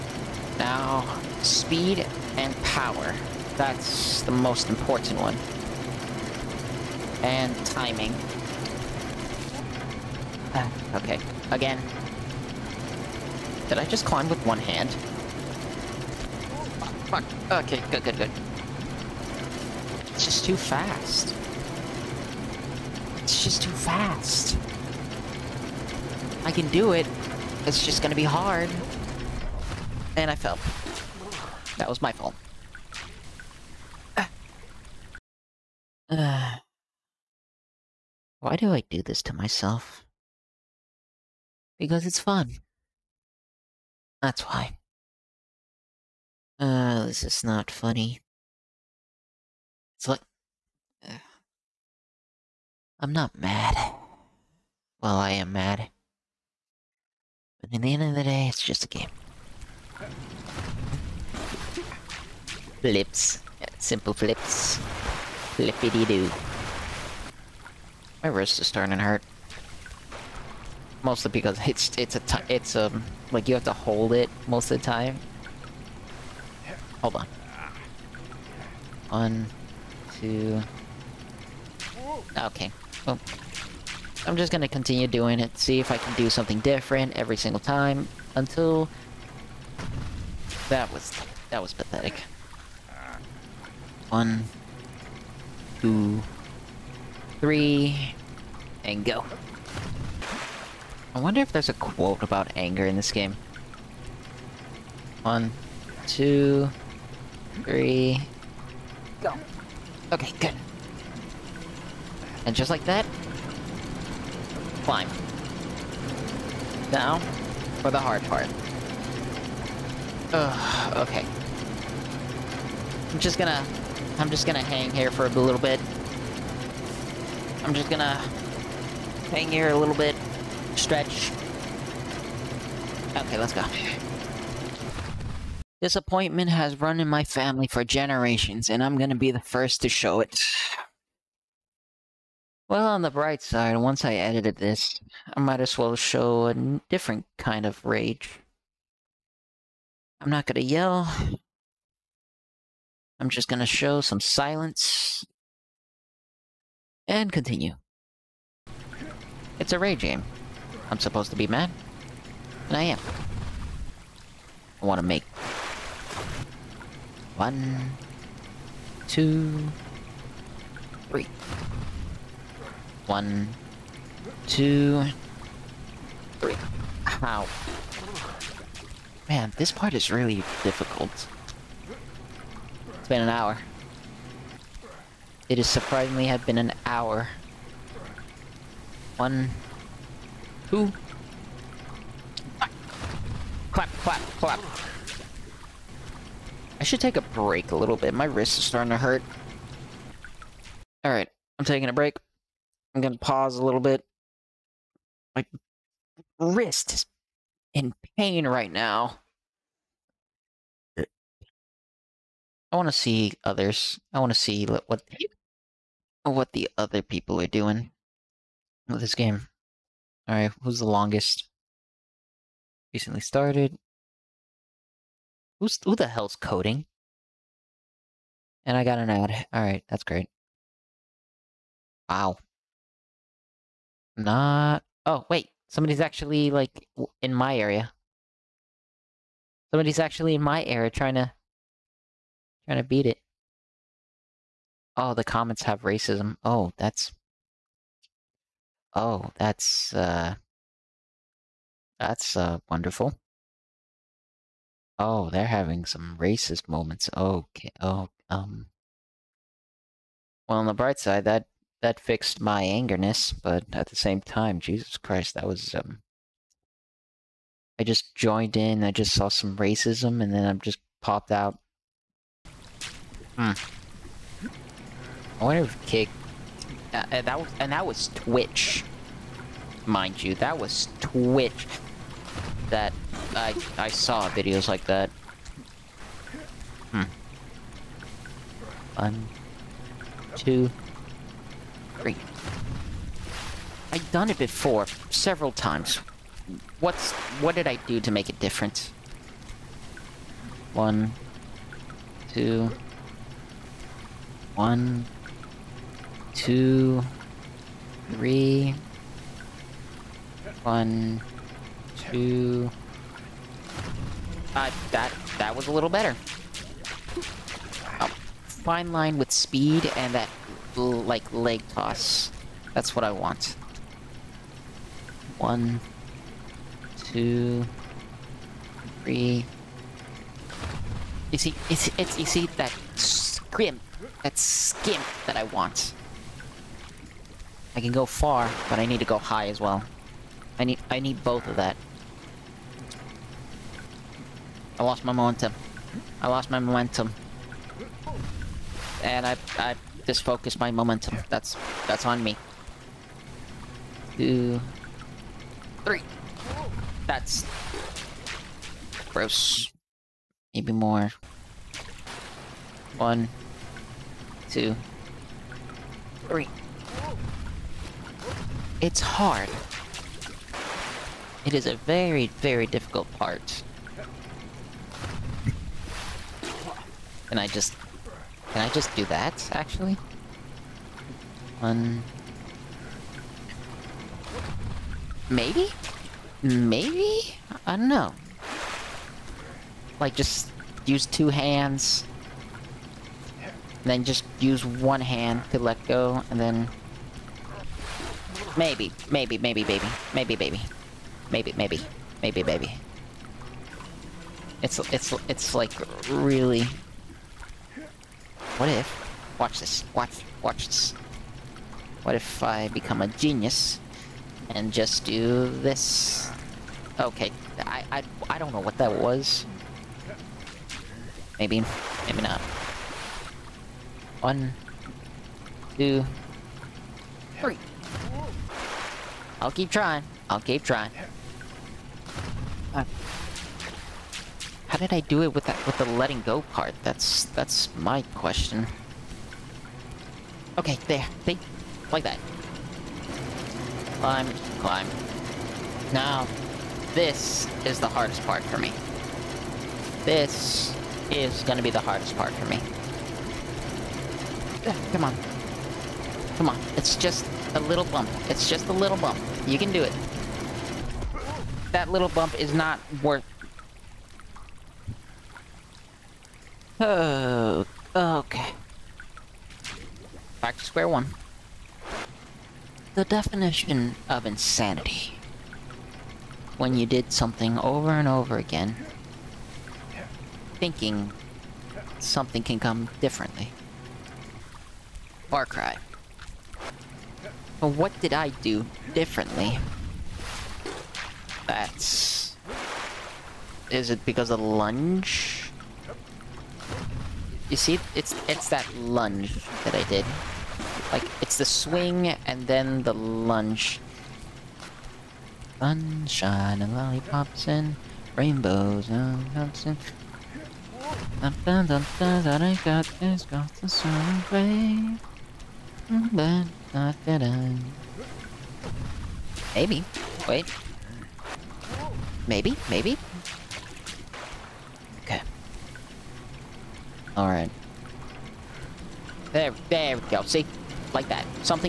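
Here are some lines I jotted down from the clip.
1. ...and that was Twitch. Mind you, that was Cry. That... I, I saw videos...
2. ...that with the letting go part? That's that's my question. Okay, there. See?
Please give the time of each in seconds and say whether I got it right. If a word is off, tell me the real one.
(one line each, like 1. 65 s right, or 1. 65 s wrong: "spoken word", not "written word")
1. 277 s wrong: "Twitch", not "Cry"
2. 435 s right.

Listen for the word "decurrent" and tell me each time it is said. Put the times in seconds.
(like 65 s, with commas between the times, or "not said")
not said.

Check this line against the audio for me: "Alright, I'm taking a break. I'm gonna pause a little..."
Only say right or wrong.
right.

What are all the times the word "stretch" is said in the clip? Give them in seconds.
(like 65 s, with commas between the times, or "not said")
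130 s.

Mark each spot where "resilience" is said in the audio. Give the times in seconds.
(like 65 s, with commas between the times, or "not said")
not said.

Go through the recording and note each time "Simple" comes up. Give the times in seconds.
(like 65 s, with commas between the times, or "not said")
63 s.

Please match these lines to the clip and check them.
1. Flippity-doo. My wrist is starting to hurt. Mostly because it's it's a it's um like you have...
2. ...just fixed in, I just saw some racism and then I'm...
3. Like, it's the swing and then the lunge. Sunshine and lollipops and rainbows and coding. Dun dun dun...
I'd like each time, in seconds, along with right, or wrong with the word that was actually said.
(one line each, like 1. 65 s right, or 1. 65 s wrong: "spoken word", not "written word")
1. 65 s right
2. 267 s wrong: "joined", not "fixed"
3. 500 s wrong: "dancing", not "coding".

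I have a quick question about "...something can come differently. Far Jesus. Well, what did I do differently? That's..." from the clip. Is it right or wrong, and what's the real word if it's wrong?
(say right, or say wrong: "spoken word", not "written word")
wrong: "Cry", not "Jesus".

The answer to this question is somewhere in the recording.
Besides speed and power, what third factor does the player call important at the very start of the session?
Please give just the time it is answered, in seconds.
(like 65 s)
7 s.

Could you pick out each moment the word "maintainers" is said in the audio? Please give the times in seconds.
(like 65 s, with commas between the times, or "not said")
not said.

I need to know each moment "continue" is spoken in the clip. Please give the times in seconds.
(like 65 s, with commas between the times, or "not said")
84 s, 157 s.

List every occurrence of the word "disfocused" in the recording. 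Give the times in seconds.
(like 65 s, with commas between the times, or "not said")
350 s.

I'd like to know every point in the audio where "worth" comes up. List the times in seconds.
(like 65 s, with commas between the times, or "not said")
463 s.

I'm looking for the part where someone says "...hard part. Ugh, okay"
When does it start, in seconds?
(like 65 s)
117 s.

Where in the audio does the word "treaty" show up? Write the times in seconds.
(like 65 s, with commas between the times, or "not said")
not said.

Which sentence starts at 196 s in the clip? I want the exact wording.
I should take a break a little bit.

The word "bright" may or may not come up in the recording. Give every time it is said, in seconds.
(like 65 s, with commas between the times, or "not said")
143 s, 260 s.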